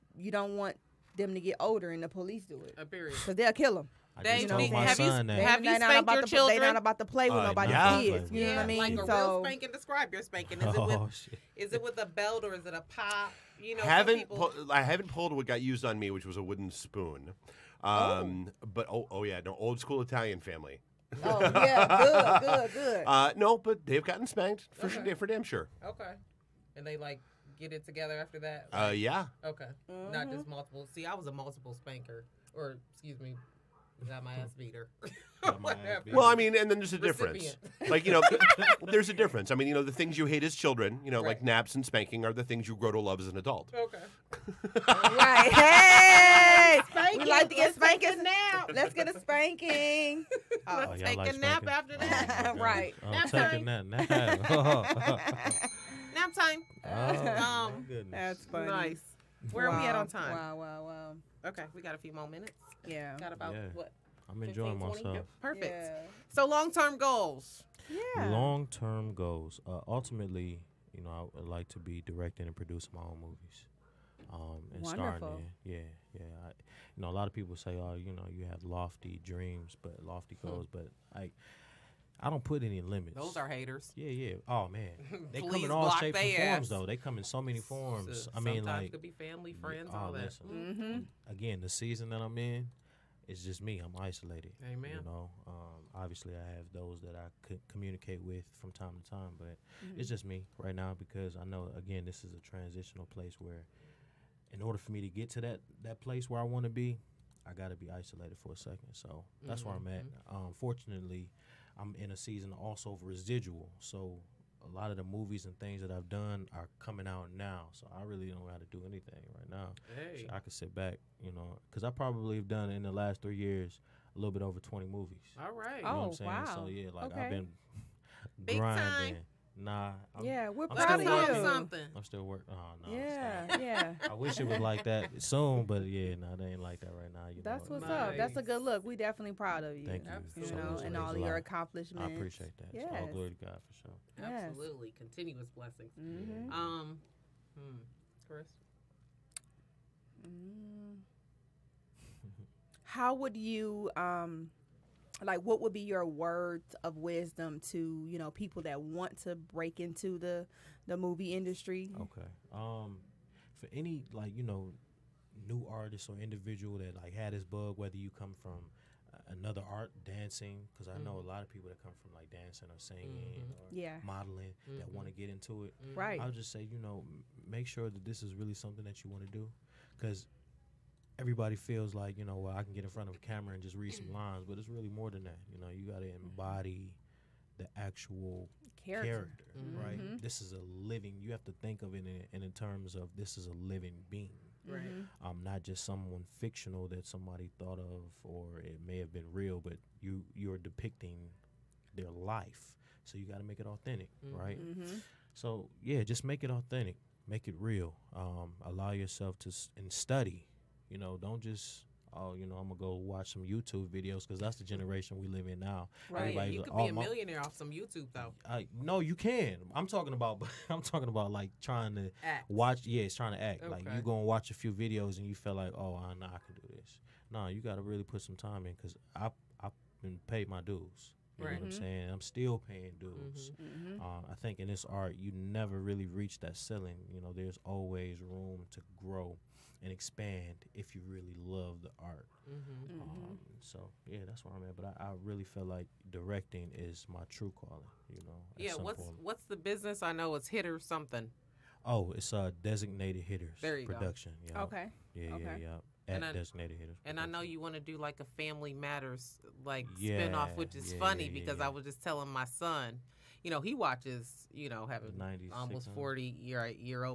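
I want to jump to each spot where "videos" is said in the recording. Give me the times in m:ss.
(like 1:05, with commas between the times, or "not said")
3:33, 3:44.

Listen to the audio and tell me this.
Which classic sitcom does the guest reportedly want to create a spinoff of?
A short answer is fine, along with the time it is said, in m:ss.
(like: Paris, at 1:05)
Family Matters, at 4:18.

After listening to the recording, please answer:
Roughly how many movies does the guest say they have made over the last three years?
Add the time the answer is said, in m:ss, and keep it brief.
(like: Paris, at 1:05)
20, at 2:04.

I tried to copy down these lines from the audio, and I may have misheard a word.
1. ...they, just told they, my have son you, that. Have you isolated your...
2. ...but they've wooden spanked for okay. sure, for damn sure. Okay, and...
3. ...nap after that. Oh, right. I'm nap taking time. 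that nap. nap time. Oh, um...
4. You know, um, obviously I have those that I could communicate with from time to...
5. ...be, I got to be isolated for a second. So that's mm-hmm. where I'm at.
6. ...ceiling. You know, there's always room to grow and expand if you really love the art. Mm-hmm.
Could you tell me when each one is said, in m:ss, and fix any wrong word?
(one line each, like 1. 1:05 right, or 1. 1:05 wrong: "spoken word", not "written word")
1. 0:04 wrong: "spanked", not "isolated"
2. 0:23 wrong: "gotten", not "wooden"
3. 0:51 right
4. 1:34 right
5. 1:46 right
6. 3:56 right.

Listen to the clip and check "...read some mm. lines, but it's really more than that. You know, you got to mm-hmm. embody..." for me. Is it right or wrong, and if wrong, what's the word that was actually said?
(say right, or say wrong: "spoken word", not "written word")
right.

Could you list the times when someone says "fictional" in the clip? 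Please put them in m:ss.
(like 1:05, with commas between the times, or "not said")
3:16.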